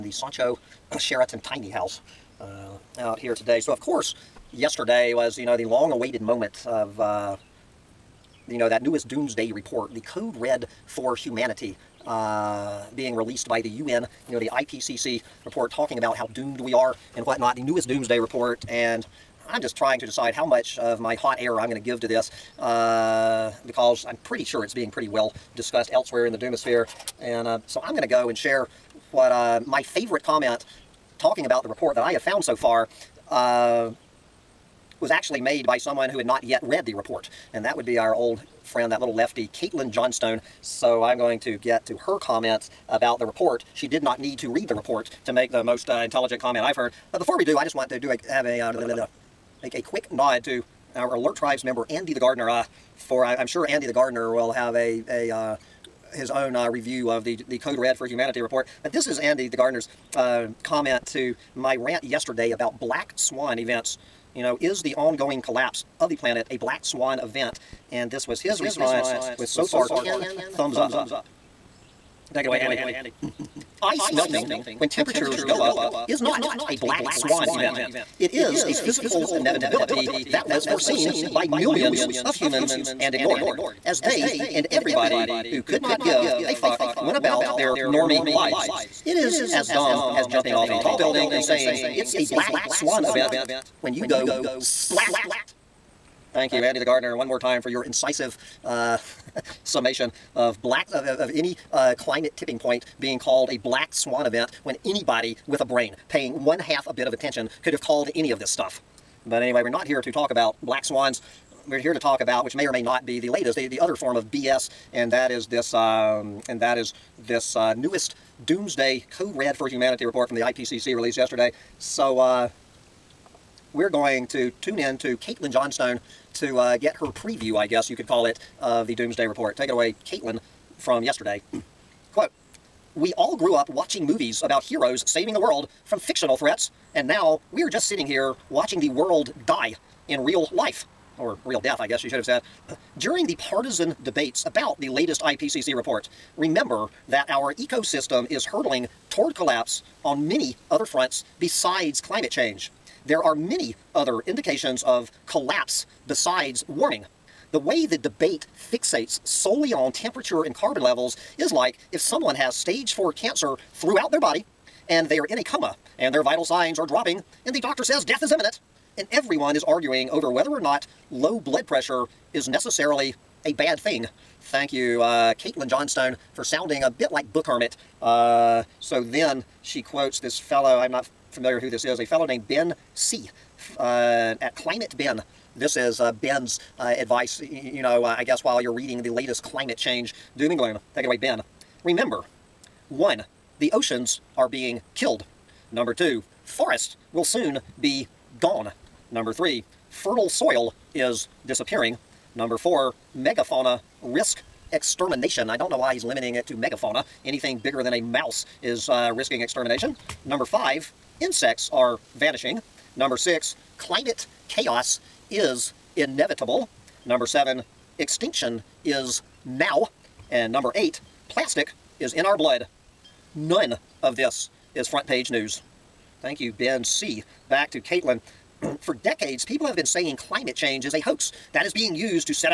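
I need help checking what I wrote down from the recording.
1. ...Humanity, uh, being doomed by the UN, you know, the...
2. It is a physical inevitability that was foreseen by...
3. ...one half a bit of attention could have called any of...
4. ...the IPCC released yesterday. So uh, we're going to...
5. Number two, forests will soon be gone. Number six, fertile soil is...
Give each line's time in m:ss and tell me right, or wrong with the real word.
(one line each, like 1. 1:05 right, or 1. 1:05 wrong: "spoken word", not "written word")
1. 0:11 wrong: "released", not "doomed"
2. 1:18 right
3. 1:46 right
4. 2:00 right
5. 3:15 wrong: "three", not "six".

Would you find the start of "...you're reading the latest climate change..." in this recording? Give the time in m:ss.
3:08.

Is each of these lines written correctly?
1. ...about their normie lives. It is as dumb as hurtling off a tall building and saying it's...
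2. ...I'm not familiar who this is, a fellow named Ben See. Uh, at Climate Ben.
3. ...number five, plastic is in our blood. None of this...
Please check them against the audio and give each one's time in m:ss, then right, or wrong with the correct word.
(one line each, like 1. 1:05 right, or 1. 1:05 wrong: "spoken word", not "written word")
1. 1:27 wrong: "jumping", not "hurtling"
2. 3:00 right
3. 3:40 wrong: "eight", not "five".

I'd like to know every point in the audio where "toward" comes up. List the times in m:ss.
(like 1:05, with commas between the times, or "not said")
2:29.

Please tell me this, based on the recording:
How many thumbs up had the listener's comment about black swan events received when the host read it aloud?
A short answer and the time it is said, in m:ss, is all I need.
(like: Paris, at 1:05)
10, at 1:09.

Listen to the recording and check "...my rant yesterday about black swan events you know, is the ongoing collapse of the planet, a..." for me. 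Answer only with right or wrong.
right.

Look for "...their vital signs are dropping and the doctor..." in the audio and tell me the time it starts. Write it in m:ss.
2:46.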